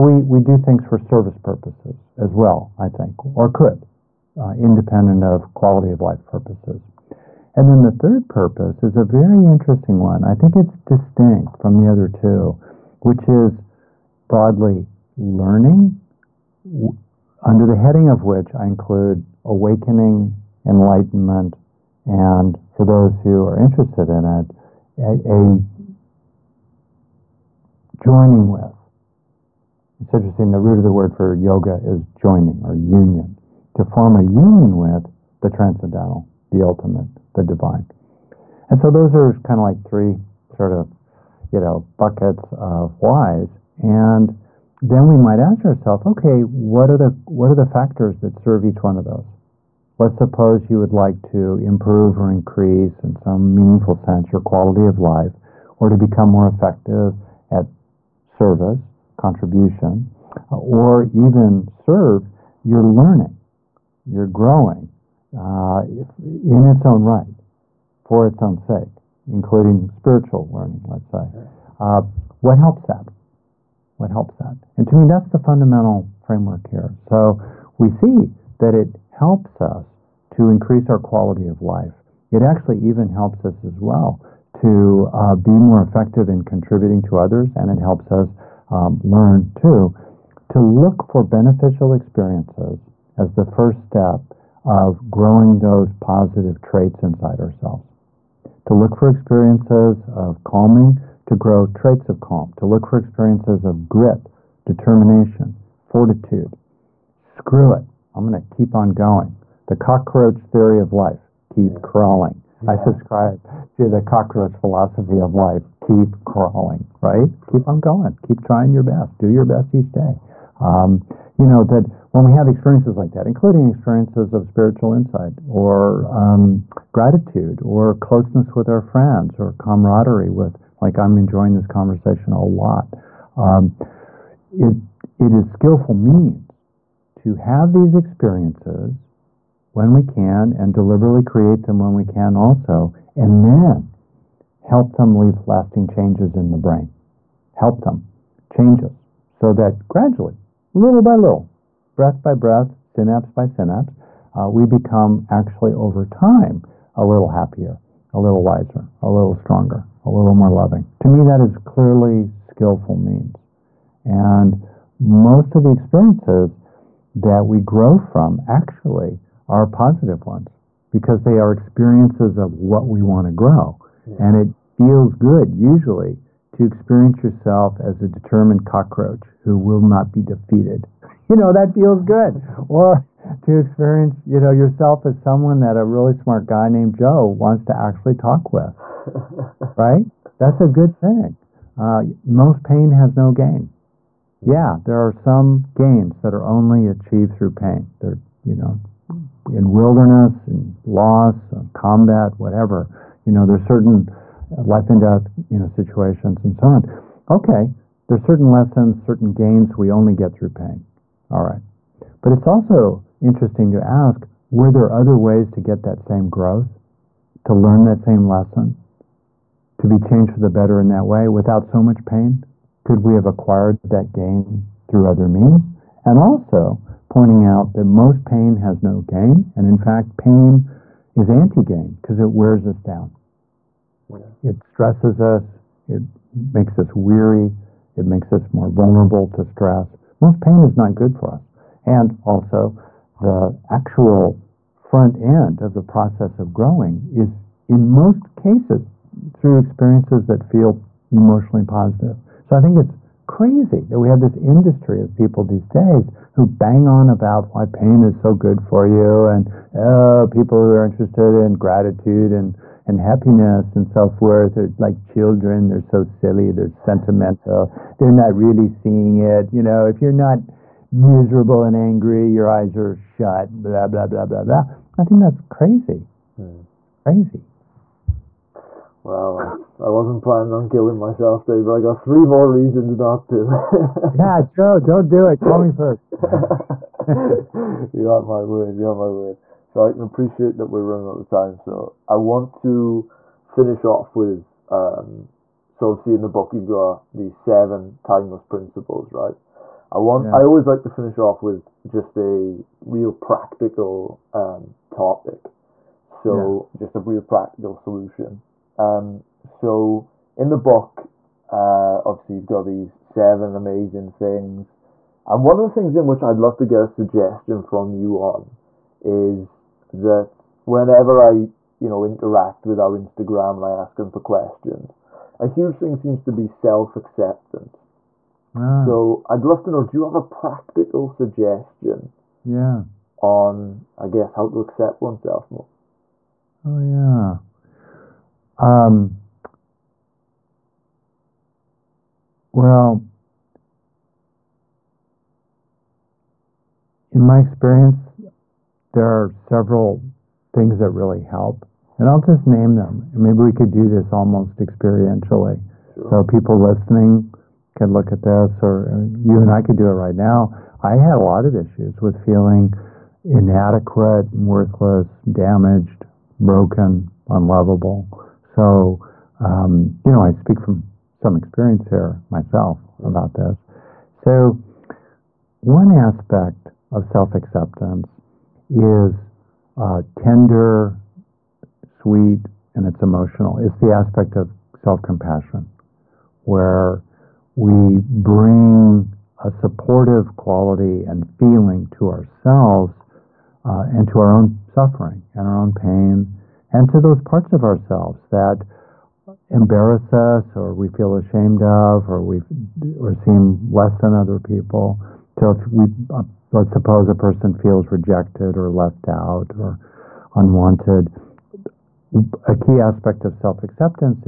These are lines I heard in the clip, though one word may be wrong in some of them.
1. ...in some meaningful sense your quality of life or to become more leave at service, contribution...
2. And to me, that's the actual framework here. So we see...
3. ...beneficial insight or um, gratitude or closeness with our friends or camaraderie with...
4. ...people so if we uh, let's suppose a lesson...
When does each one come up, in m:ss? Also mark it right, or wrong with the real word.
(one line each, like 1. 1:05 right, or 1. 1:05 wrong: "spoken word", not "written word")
1. 0:53 wrong: "effective", not "leave"
2. 1:14 wrong: "fundamental", not "actual"
3. 2:04 wrong: "spiritual", not "beneficial"
4. 6:44 wrong: "person", not "lesson".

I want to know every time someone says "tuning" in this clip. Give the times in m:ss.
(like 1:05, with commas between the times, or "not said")
not said.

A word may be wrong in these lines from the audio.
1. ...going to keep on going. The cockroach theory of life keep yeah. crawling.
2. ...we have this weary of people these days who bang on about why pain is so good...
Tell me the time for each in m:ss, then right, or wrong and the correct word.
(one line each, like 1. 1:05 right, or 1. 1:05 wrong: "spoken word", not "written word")
1. 1:48 right
2. 4:13 wrong: "industry", not "weary".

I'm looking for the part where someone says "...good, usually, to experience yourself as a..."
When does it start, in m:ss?
2:55.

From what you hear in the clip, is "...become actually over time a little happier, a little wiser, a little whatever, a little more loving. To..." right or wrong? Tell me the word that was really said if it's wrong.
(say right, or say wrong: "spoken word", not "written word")
wrong: "stronger", not "whatever".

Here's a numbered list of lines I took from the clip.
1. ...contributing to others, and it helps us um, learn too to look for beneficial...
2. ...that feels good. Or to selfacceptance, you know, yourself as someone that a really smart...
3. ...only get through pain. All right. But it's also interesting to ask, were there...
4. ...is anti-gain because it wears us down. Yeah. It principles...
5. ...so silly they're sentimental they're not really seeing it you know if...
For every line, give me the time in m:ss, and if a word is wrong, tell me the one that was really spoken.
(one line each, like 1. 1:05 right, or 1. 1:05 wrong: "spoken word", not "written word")
1. 1:26 right
2. 3:01 wrong: "experience", not "selfacceptance"
3. 3:29 right
4. 3:51 wrong: "stresses", not "principles"
5. 4:25 right.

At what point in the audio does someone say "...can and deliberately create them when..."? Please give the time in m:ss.
2:20.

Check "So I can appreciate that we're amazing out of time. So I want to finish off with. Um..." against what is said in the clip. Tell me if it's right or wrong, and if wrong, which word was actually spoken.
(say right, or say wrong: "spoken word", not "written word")
wrong: "running", not "amazing".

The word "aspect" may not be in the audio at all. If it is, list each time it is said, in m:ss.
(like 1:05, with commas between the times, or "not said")
6:15, 6:23, 6:52.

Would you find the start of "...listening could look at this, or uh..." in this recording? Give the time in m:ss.
5:56.